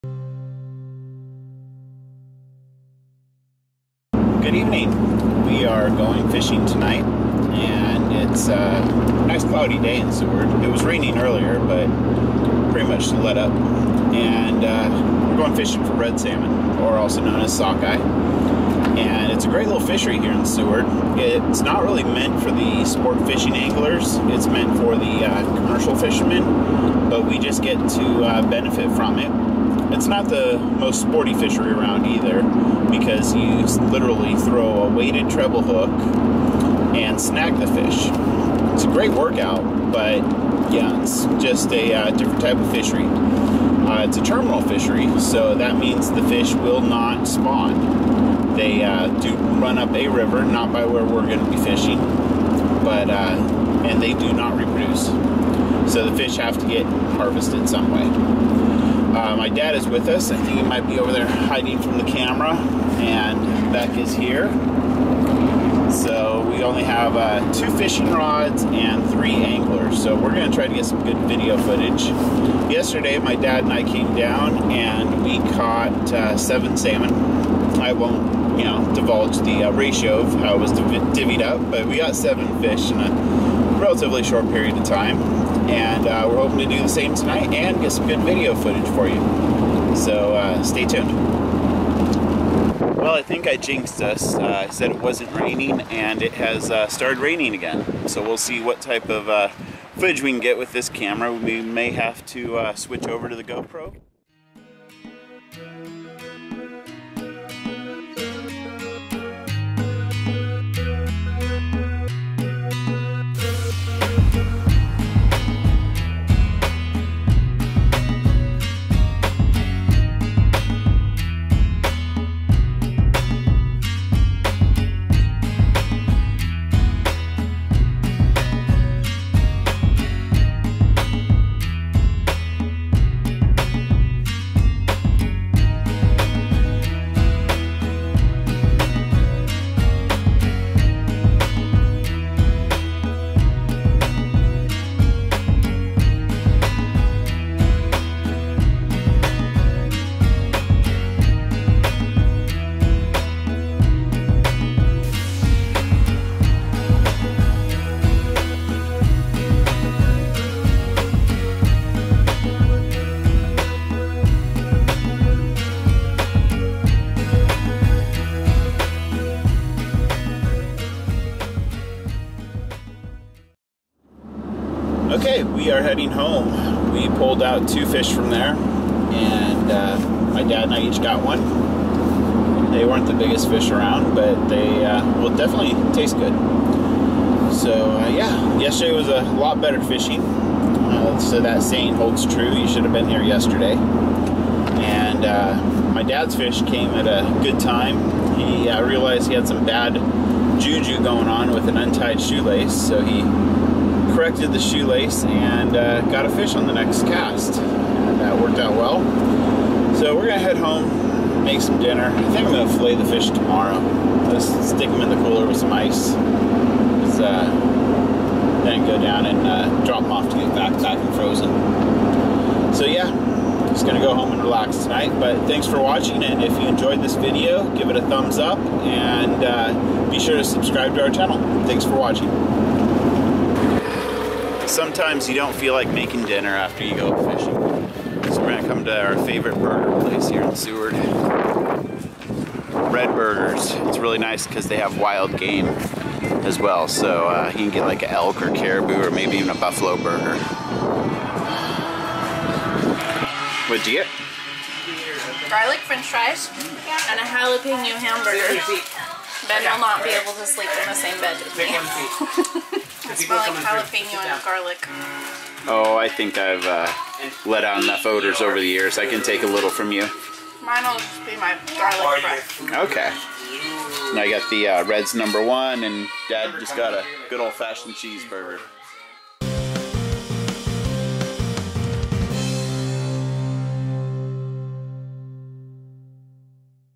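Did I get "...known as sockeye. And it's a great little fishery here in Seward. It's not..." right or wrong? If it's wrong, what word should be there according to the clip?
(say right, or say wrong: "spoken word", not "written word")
right.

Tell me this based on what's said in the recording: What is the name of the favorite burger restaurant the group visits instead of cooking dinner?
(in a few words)
Red Burgers.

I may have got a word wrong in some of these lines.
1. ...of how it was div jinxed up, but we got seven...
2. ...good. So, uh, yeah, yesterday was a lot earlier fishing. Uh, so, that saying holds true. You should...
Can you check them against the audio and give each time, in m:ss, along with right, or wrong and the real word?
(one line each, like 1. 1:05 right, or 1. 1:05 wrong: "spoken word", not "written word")
1. 1:20 wrong: "divvied", not "jinxed"
2. 3:06 wrong: "better", not "earlier".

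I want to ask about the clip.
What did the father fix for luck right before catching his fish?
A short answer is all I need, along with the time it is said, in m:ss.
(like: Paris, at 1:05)
Untied shoelace, at 3:21.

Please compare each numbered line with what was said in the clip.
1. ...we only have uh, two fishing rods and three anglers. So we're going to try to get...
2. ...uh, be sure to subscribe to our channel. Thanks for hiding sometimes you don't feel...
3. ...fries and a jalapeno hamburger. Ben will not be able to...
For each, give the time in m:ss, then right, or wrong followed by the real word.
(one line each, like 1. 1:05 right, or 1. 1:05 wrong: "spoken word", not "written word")
1. 1:06 right
2. 3:49 wrong: "watching", not "hiding"
3. 4:16 right.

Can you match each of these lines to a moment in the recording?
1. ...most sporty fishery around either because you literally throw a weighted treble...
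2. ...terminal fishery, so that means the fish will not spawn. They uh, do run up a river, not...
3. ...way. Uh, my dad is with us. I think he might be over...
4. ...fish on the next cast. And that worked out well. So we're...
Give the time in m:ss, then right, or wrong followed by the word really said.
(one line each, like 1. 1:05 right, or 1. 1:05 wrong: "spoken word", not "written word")
1. 0:30 right
2. 0:44 right
3. 0:57 right
4. 3:26 right.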